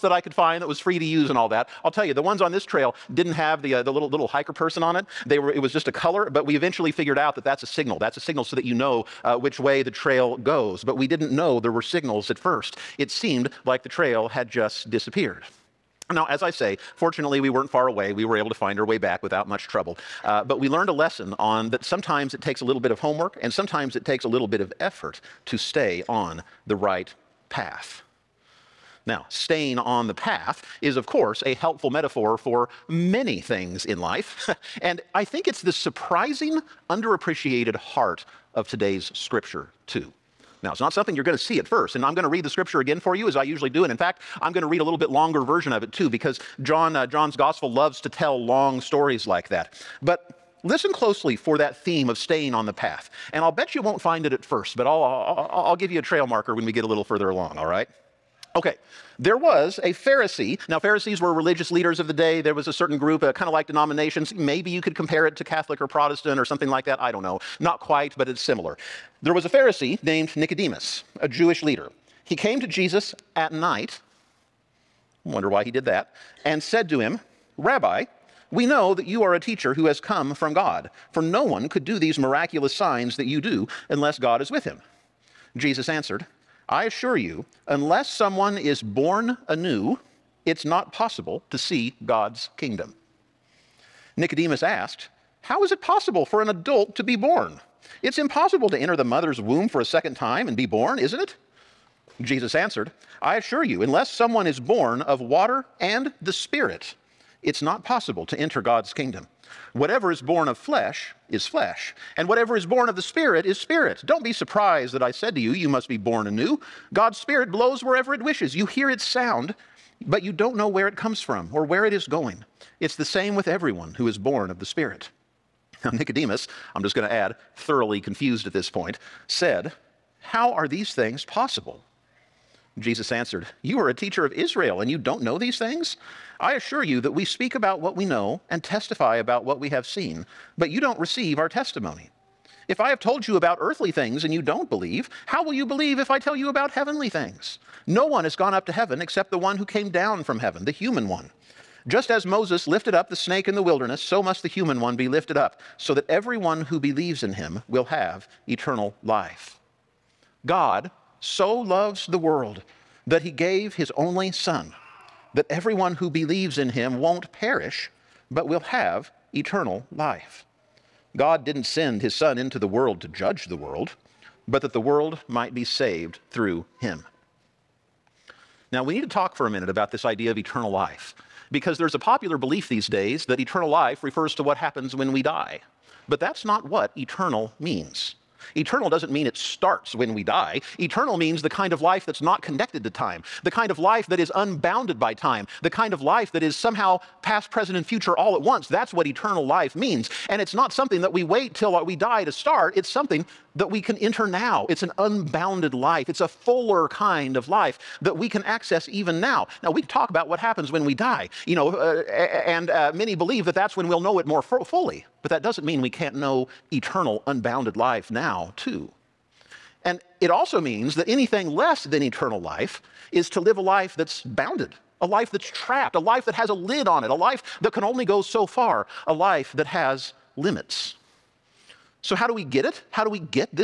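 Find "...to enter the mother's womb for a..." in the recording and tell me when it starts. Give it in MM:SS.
01:38.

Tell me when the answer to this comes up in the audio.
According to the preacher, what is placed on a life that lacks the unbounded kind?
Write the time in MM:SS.
03:46.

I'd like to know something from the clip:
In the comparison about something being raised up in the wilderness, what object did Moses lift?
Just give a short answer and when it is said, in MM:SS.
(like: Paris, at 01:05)
the snake, at 02:33.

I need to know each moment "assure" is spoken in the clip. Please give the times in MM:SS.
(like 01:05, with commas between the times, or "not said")
01:26, 01:43, 02:16.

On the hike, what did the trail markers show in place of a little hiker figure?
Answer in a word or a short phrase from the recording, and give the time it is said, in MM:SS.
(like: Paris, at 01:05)
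just a color, at 00:05.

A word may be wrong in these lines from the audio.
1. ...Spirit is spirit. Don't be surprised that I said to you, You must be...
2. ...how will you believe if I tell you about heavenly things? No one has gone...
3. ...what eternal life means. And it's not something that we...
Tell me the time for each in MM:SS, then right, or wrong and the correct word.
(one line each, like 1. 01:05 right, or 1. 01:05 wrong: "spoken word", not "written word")
1. 01:53 right
2. 02:25 right
3. 03:18 right.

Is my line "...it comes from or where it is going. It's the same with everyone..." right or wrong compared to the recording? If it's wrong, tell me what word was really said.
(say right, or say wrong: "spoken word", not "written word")
right.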